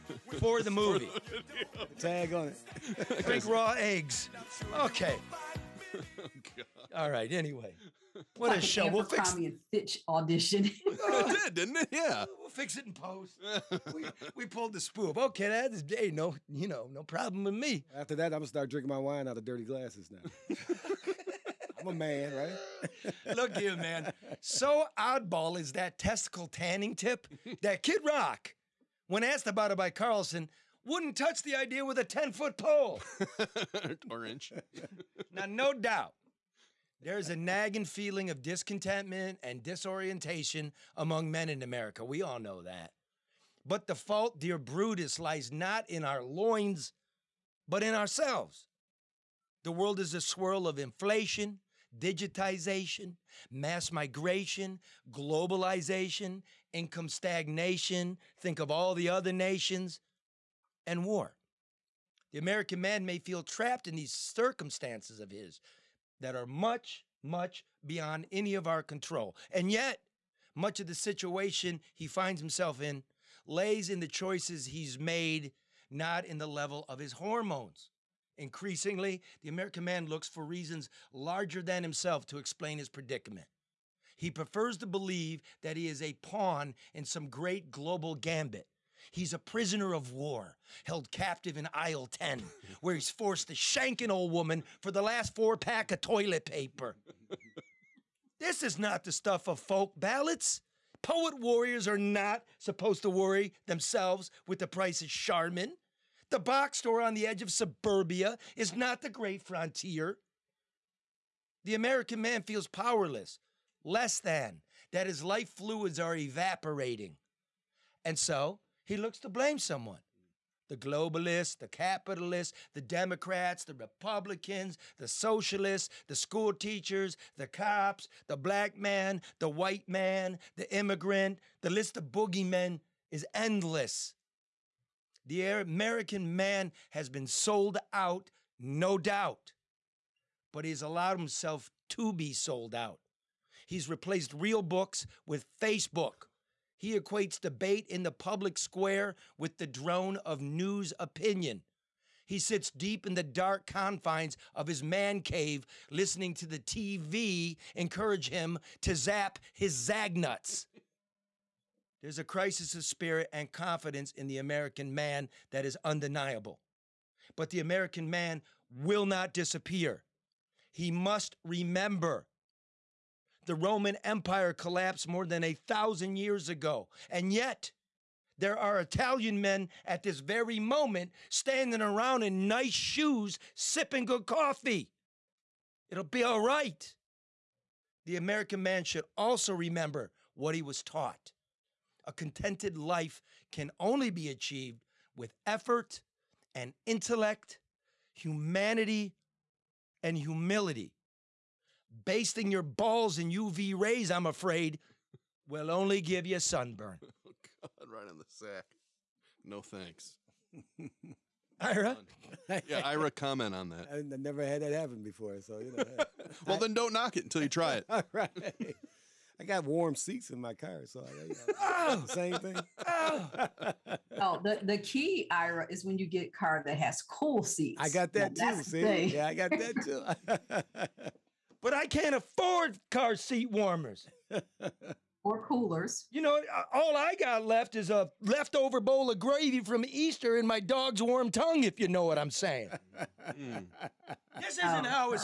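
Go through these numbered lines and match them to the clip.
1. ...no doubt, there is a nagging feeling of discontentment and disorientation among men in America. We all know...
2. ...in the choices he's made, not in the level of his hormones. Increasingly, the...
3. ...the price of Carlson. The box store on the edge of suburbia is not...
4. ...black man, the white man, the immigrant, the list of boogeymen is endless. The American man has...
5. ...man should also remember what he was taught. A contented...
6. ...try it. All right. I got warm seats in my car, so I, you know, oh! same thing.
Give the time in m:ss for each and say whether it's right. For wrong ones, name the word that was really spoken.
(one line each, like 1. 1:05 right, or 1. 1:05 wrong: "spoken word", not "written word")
1. 0:35 right
2. 1:13 right
3. 1:44 wrong: "Charmin", not "Carlson"
4. 2:08 right
5. 3:08 right
6. 3:37 right.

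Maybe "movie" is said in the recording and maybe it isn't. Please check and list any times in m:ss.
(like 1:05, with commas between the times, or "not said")
0:00.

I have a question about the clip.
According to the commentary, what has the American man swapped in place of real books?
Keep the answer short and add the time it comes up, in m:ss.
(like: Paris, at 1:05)
Facebook, at 2:25.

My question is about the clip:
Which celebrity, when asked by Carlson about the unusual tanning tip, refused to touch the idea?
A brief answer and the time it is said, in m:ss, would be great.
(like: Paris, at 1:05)
Kid Rock, at 0:27.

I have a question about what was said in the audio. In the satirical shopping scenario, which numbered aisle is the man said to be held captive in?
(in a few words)
aisle 10.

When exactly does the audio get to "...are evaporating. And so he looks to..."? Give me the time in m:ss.
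1:55.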